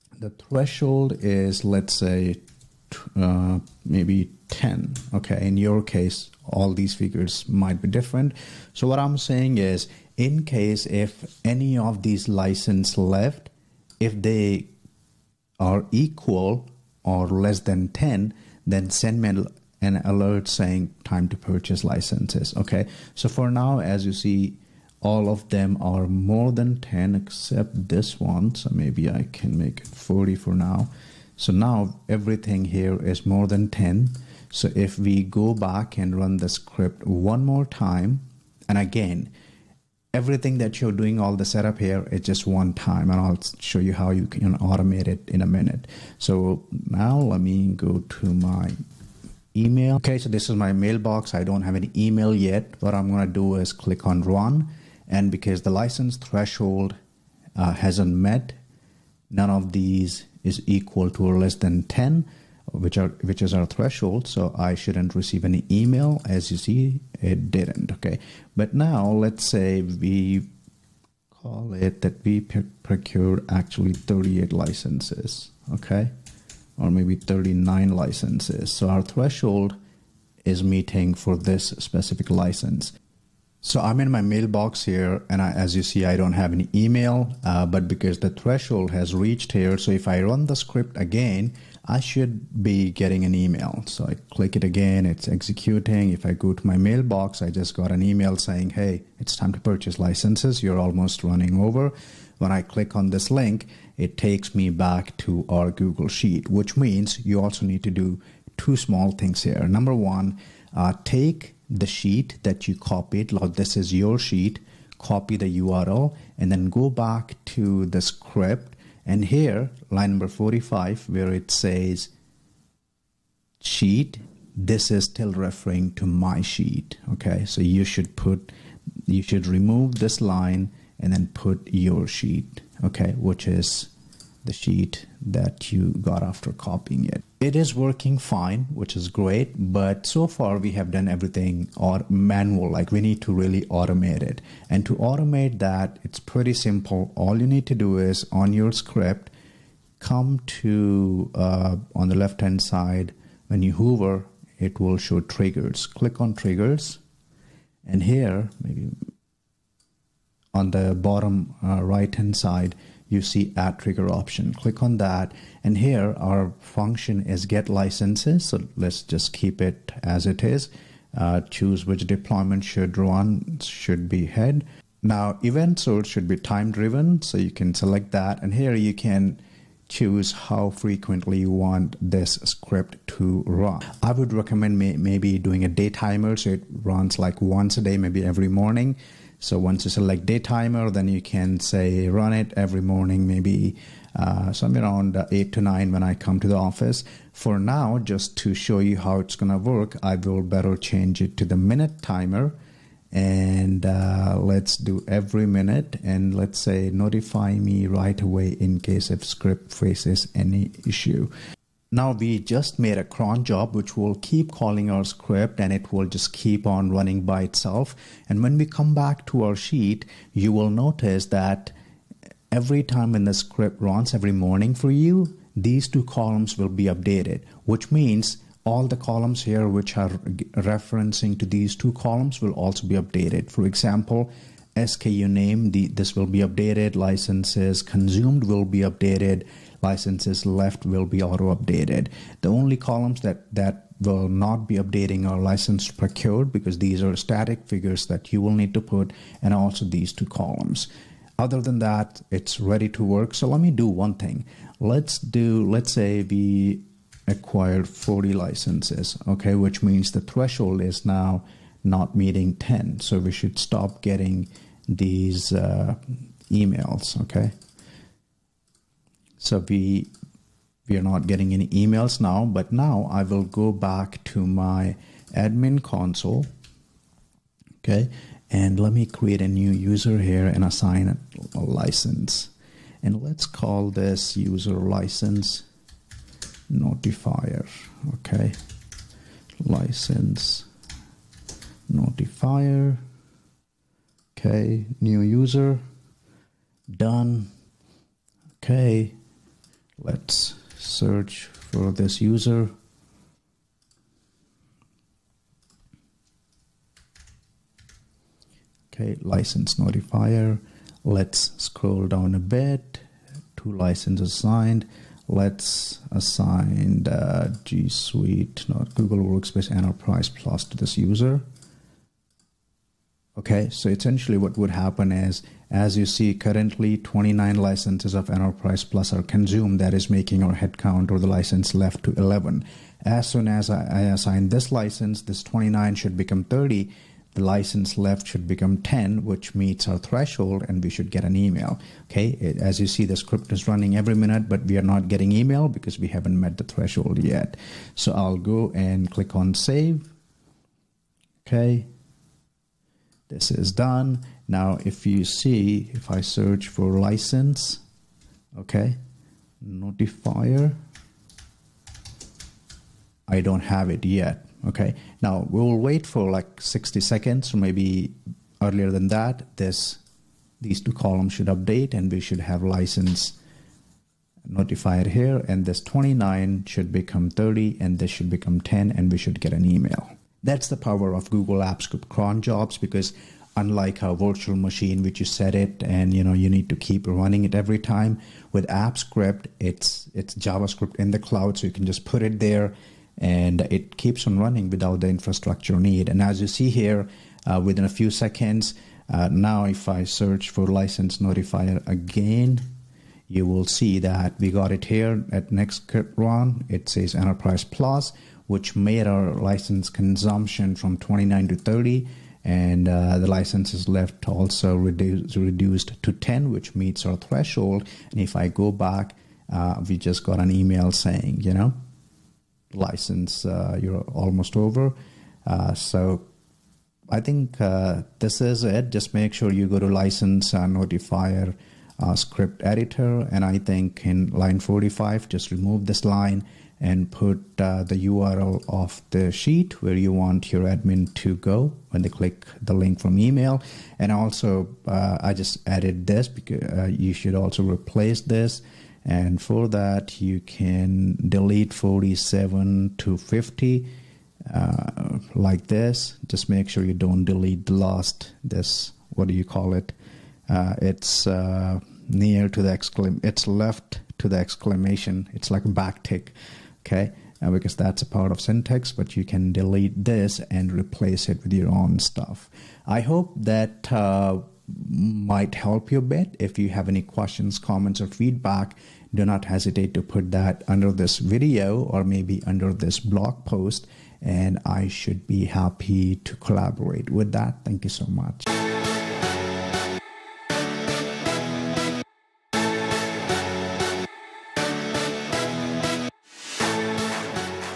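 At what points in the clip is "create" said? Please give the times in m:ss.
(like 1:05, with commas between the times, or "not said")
4:39.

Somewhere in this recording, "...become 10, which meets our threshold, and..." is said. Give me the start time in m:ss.
5:38.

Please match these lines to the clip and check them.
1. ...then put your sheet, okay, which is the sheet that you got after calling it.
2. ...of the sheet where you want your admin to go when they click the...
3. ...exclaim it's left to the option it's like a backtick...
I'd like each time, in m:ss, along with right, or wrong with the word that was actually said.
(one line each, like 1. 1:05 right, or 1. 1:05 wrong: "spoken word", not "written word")
1. 2:11 wrong: "copying", not "calling"
2. 7:18 right
3. 7:42 wrong: "exclamation", not "option".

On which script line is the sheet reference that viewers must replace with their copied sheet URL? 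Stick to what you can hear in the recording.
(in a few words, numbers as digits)
45.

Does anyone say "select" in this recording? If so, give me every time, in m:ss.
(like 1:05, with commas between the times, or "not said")
2:57, 3:09.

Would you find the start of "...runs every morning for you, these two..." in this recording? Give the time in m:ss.
3:43.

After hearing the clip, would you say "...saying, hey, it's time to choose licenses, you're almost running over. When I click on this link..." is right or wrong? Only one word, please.
wrong.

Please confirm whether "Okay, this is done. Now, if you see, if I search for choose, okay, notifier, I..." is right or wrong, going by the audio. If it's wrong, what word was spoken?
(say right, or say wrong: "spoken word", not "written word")
wrong: "license", not "choose".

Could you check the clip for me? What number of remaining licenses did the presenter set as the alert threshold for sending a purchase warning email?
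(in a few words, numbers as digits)
10.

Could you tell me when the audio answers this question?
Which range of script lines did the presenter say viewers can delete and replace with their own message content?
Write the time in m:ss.
7:31.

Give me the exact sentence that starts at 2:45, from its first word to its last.
And here our function is get licenses.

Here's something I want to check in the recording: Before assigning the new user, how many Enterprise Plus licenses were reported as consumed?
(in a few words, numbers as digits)
29.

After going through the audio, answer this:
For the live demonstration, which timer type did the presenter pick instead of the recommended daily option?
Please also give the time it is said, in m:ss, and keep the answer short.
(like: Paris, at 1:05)
minute timer, at 3:21.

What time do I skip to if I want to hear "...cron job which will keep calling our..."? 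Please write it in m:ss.
3:33.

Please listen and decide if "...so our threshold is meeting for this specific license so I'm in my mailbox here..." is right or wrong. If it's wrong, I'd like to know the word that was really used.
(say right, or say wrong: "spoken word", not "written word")
right.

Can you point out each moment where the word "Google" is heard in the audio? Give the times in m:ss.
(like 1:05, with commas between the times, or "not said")
1:45, 5:18, 6:21.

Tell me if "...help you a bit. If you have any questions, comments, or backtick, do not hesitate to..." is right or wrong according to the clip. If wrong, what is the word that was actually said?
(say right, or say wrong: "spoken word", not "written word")
wrong: "feedback", not "backtick".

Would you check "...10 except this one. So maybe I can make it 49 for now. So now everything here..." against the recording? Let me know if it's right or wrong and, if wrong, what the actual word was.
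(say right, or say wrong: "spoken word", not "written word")
wrong: "40", not "49".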